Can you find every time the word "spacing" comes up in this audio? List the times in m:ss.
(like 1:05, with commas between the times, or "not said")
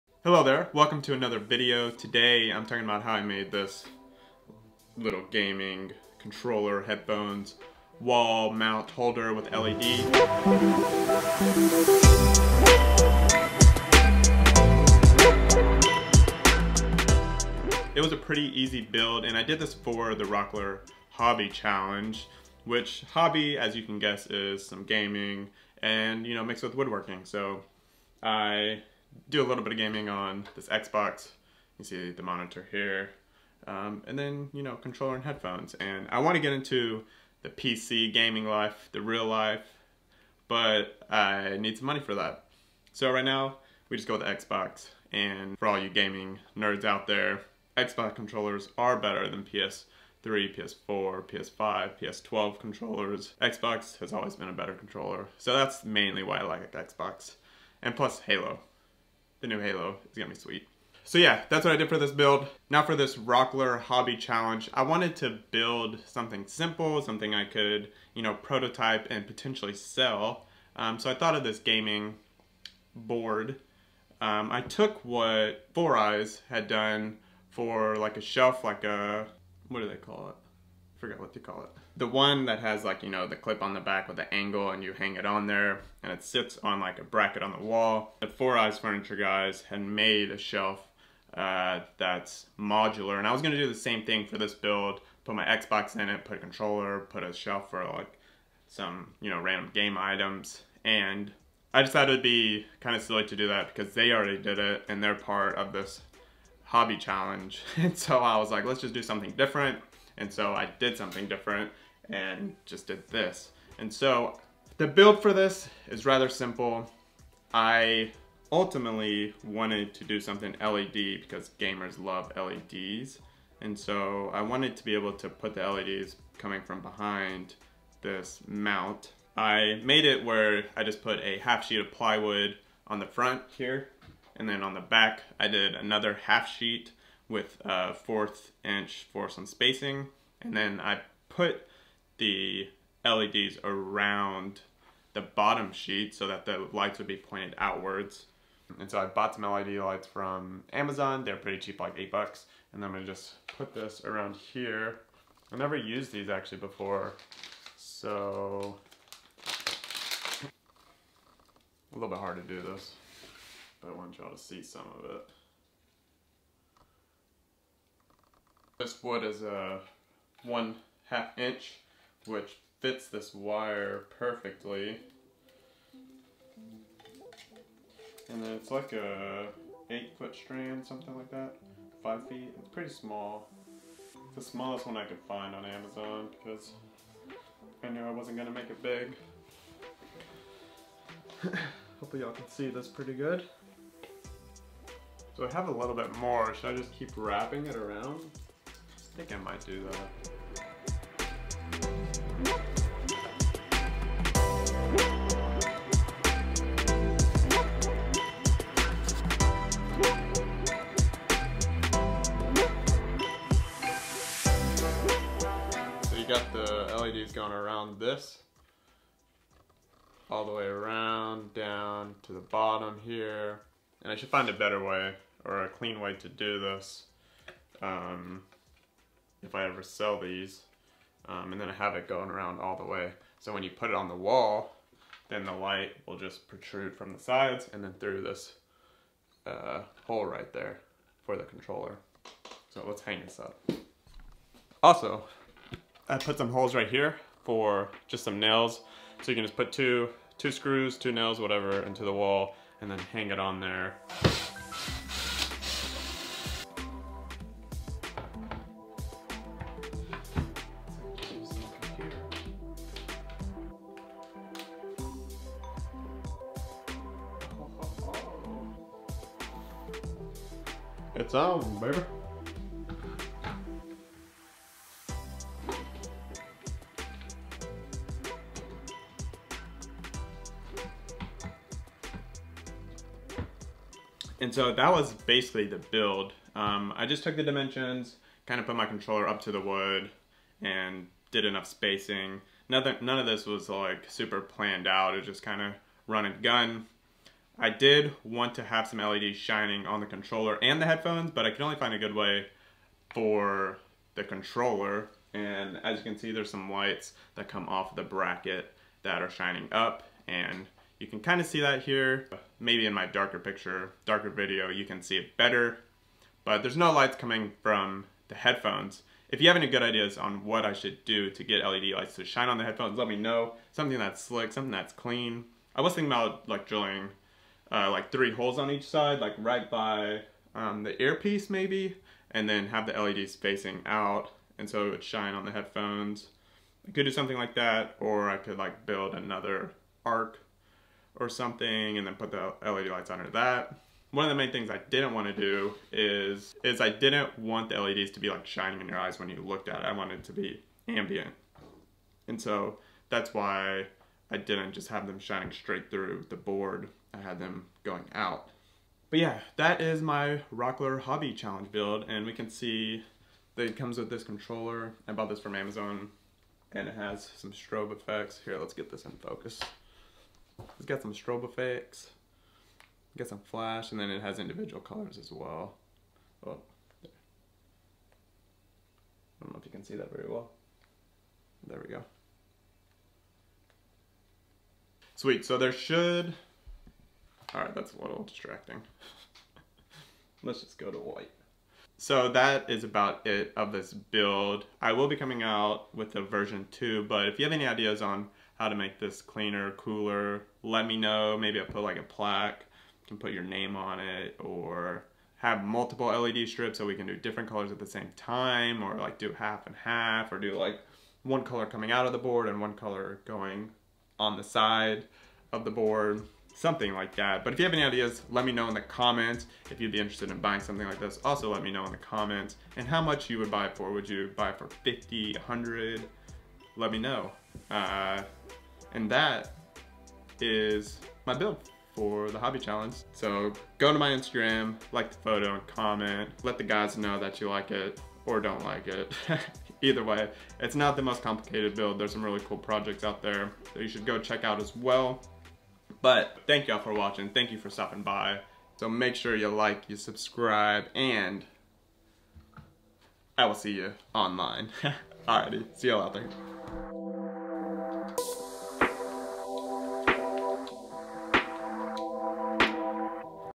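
2:19, 4:51.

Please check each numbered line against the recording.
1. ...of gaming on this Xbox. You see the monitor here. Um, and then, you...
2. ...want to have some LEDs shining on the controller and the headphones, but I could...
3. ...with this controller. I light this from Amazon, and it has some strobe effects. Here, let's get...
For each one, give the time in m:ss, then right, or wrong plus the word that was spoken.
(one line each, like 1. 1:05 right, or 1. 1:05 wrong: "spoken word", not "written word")
1. 0:29 right
2. 4:58 right
3. 6:03 wrong: "bought", not "light".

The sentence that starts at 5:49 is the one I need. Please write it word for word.
I wanted it to be ambient.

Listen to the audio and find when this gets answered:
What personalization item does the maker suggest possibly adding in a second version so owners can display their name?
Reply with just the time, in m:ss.
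6:42.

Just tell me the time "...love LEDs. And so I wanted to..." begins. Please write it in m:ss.
2:02.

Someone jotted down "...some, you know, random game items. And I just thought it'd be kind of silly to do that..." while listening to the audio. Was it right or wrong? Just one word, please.
right.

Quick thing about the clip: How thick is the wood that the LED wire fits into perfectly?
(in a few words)
1/2 inch.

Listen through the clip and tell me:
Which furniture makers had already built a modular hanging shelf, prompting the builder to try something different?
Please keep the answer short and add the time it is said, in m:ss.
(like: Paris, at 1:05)
Four Eyes Furniture, at 1:28.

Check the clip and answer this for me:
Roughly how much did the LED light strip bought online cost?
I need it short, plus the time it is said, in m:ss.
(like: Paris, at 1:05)
8 dollars, at 2:31.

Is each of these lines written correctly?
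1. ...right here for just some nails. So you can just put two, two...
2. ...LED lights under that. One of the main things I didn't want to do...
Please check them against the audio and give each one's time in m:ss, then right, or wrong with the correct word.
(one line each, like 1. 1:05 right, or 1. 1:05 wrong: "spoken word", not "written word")
1. 4:06 right
2. 5:42 right.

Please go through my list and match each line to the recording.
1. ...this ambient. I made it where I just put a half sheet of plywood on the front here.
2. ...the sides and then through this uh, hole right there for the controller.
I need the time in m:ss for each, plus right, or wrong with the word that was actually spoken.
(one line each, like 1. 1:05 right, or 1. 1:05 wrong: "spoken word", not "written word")
1. 2:08 wrong: "mount", not "ambient"
2. 3:57 right.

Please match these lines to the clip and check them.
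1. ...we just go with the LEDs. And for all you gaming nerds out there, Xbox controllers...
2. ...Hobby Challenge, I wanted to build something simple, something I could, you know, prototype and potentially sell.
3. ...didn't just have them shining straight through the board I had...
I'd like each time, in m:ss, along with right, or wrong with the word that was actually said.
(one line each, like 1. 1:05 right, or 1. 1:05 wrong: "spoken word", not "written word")
1. 0:43 wrong: "Xbox", not "LEDs"
2. 1:03 right
3. 5:54 right.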